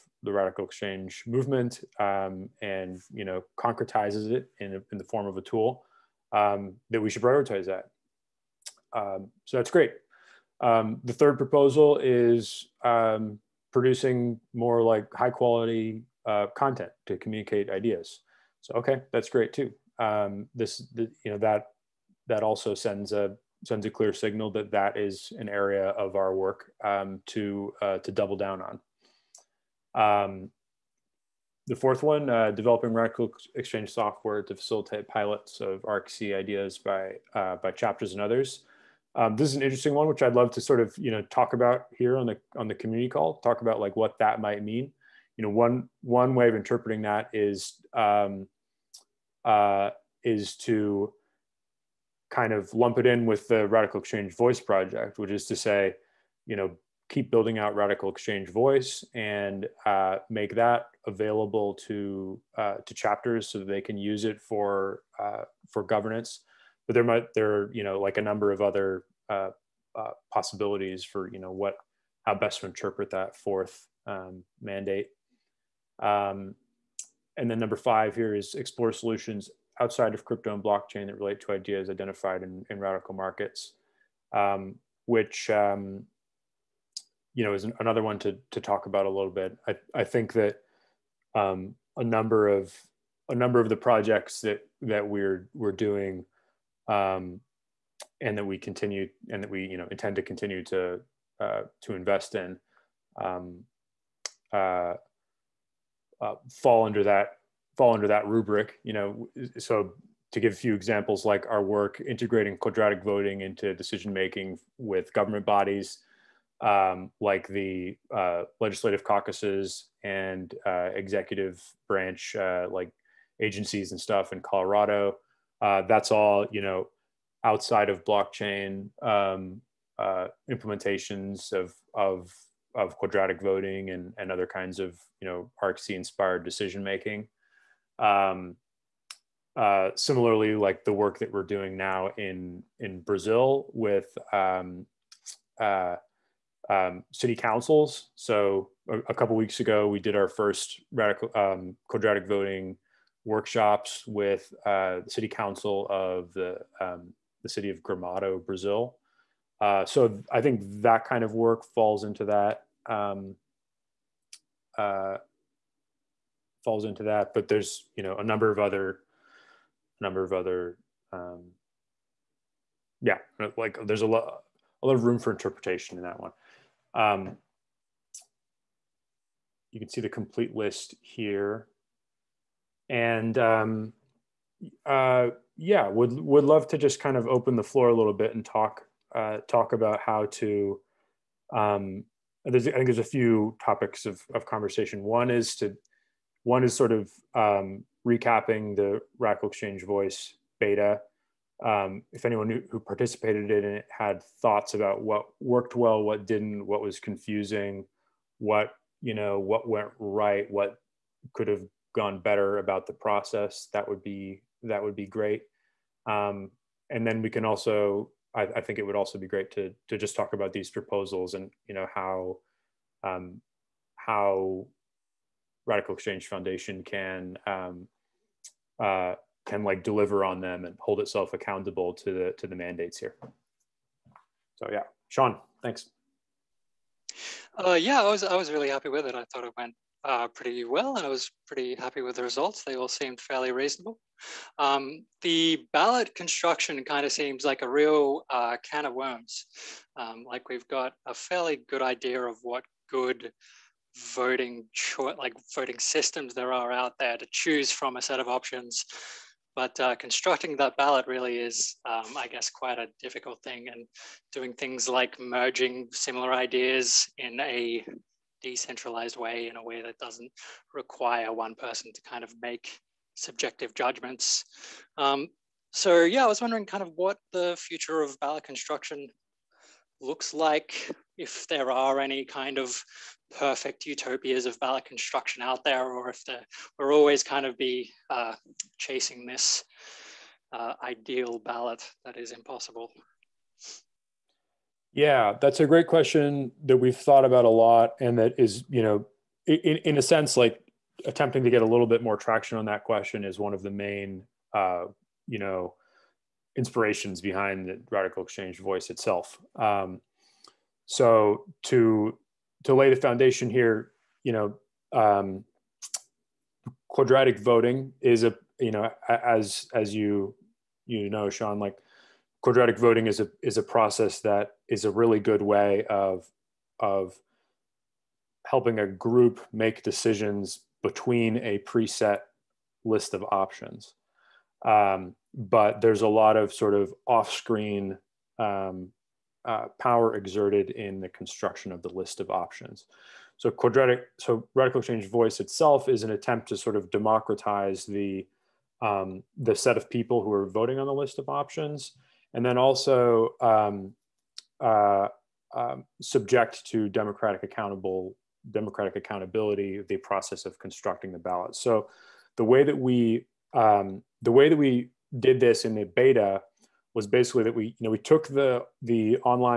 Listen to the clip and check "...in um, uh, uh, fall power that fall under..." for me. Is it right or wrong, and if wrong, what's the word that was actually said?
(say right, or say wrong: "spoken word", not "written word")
wrong: "under", not "power".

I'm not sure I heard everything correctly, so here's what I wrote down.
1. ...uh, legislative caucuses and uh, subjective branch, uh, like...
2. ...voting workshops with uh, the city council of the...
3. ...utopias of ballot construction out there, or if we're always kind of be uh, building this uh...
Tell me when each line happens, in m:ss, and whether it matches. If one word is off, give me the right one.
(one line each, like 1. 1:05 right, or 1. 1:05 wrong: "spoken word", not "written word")
1. 1:58 wrong: "executive", not "subjective"
2. 2:32 right
3. 4:43 wrong: "chasing", not "building".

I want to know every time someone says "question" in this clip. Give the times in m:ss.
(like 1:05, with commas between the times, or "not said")
4:55, 5:02.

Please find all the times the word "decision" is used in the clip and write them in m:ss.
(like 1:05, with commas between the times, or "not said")
1:53, 2:16, 5:29.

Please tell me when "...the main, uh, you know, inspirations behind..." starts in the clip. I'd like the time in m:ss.
5:03.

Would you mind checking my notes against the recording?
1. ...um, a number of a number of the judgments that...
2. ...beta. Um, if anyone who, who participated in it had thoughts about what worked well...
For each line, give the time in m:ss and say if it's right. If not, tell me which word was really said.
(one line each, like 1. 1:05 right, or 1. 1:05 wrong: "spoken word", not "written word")
1. 1:31 wrong: "projects", not "judgments"
2. 3:20 right.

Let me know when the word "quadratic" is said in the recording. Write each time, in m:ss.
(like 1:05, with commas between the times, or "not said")
1:52, 2:12, 2:31, 5:16, 5:22, 5:43.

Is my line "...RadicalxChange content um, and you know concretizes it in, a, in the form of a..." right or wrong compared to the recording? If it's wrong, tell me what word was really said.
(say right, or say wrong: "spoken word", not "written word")
wrong: "movement", not "content".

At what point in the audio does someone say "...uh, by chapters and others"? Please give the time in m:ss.
0:37.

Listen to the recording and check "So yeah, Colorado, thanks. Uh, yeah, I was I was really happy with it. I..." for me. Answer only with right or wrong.
wrong.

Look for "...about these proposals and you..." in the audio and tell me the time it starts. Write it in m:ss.
3:40.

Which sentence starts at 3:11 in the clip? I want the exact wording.
Um, there's, I think there's a few topics of, of conversation.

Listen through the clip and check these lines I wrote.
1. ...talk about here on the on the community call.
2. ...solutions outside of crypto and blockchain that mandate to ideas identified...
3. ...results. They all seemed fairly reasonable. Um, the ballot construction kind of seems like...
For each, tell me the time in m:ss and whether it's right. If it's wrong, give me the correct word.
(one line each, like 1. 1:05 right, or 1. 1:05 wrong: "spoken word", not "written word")
1. 0:41 right
2. 1:18 wrong: "relate", not "mandate"
3. 4:02 right.